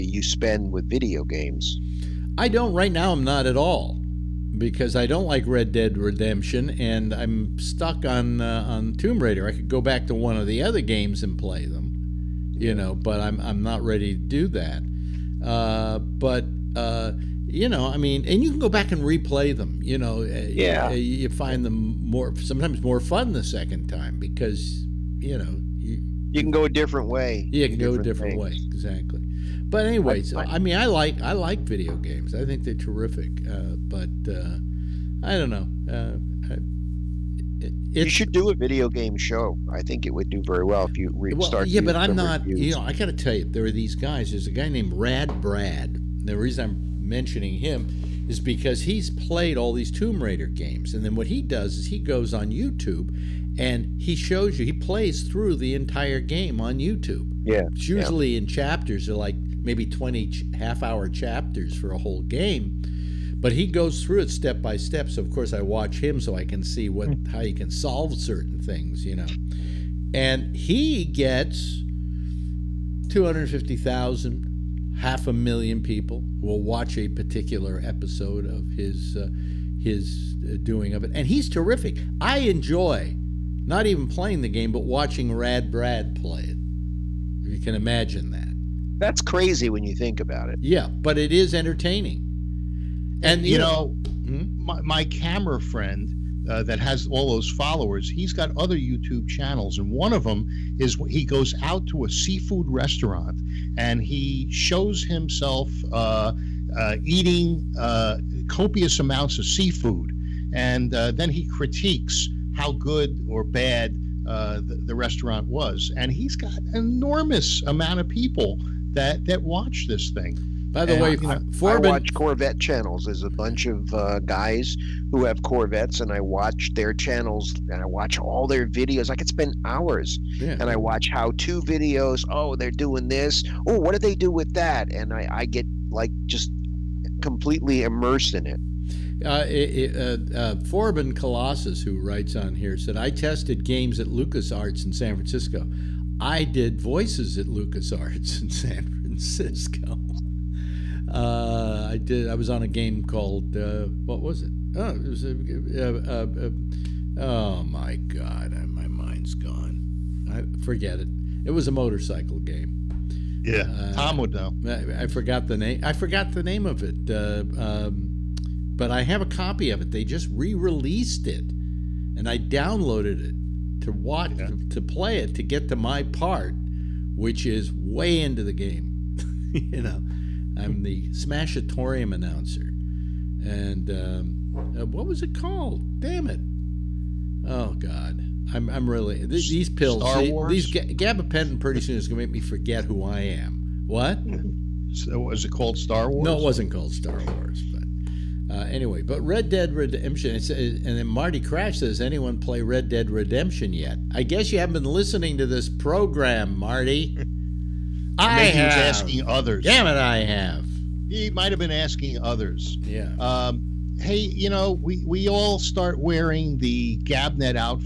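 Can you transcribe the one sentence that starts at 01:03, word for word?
But he goes through it step by step.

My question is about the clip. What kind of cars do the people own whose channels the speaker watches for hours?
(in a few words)
Corvettes.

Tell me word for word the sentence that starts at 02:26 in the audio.
I did voices at LucasArts in San Francisco.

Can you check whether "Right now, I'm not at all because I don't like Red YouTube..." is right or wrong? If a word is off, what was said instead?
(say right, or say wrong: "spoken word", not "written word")
wrong: "Dead", not "YouTube".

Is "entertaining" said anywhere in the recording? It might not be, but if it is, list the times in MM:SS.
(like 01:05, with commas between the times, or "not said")
01:31.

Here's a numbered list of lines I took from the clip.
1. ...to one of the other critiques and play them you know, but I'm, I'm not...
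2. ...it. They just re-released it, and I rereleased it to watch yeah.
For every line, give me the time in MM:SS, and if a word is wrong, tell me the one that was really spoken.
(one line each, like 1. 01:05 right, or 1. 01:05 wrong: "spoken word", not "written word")
1. 00:10 wrong: "games", not "critiques"
2. 02:49 wrong: "downloaded", not "rereleased".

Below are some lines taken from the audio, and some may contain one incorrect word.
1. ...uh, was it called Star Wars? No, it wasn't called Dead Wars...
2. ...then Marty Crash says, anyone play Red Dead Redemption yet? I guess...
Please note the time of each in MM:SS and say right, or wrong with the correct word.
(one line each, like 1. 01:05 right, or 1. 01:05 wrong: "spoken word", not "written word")
1. 03:15 wrong: "Star", not "Dead"
2. 03:20 right.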